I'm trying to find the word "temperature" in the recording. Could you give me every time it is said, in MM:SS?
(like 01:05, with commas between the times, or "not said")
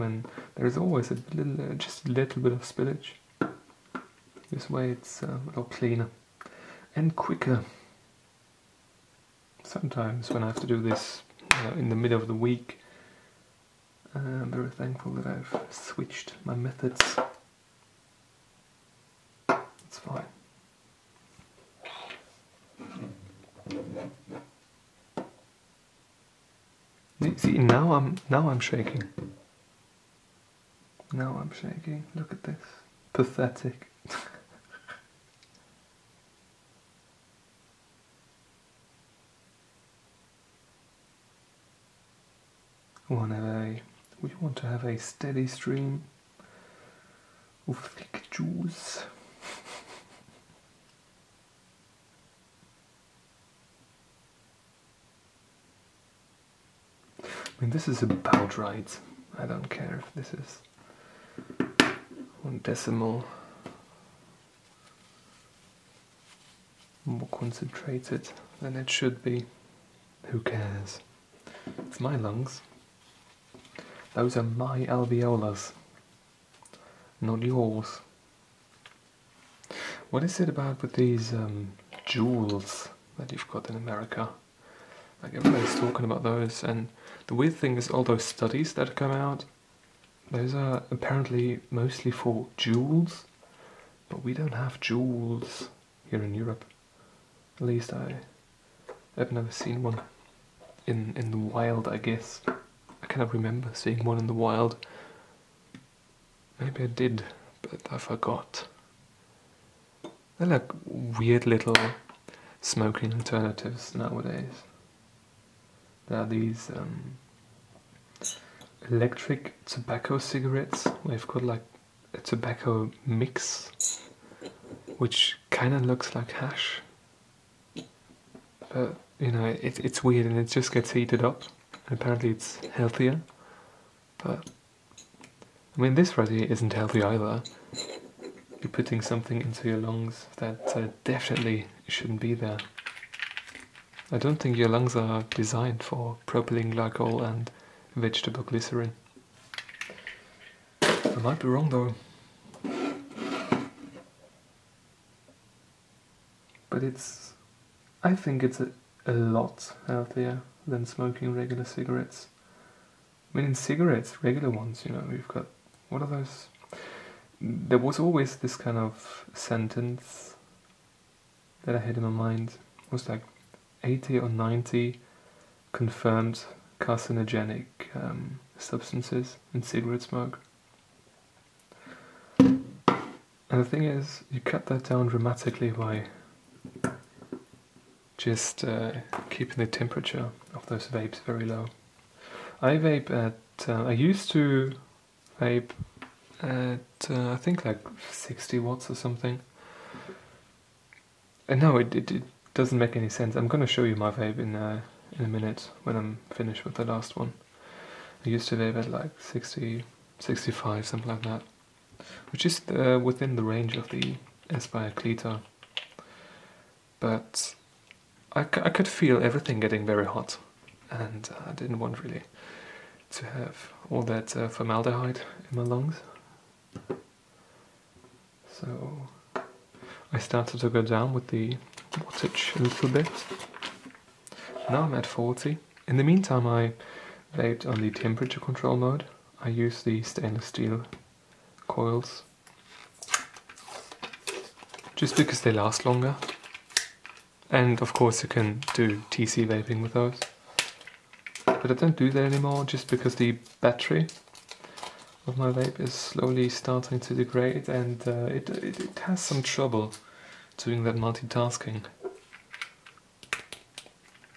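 03:09, 03:57.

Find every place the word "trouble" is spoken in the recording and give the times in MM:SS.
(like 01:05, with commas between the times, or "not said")
04:19.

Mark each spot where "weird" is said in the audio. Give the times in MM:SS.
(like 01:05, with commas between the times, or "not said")
01:27, 01:50, 02:10.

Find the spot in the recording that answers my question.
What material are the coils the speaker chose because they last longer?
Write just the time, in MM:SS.
04:00.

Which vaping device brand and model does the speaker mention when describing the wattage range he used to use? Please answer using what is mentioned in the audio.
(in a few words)
Aspire Cleito.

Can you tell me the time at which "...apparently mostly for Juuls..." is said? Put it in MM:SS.
01:30.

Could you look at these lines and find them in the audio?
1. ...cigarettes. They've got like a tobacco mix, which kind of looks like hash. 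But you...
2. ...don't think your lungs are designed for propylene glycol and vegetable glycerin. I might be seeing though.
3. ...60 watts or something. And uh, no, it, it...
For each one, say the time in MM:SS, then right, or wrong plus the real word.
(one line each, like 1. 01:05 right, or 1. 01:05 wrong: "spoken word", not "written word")
1. 02:00 right
2. 02:24 wrong: "wrong", not "seeing"
3. 03:18 right.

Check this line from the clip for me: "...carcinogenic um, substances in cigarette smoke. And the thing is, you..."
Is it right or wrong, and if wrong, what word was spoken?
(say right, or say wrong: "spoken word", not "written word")
right.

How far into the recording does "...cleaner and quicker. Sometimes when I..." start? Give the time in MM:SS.
00:05.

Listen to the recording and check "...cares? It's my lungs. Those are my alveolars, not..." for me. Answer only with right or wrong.
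right.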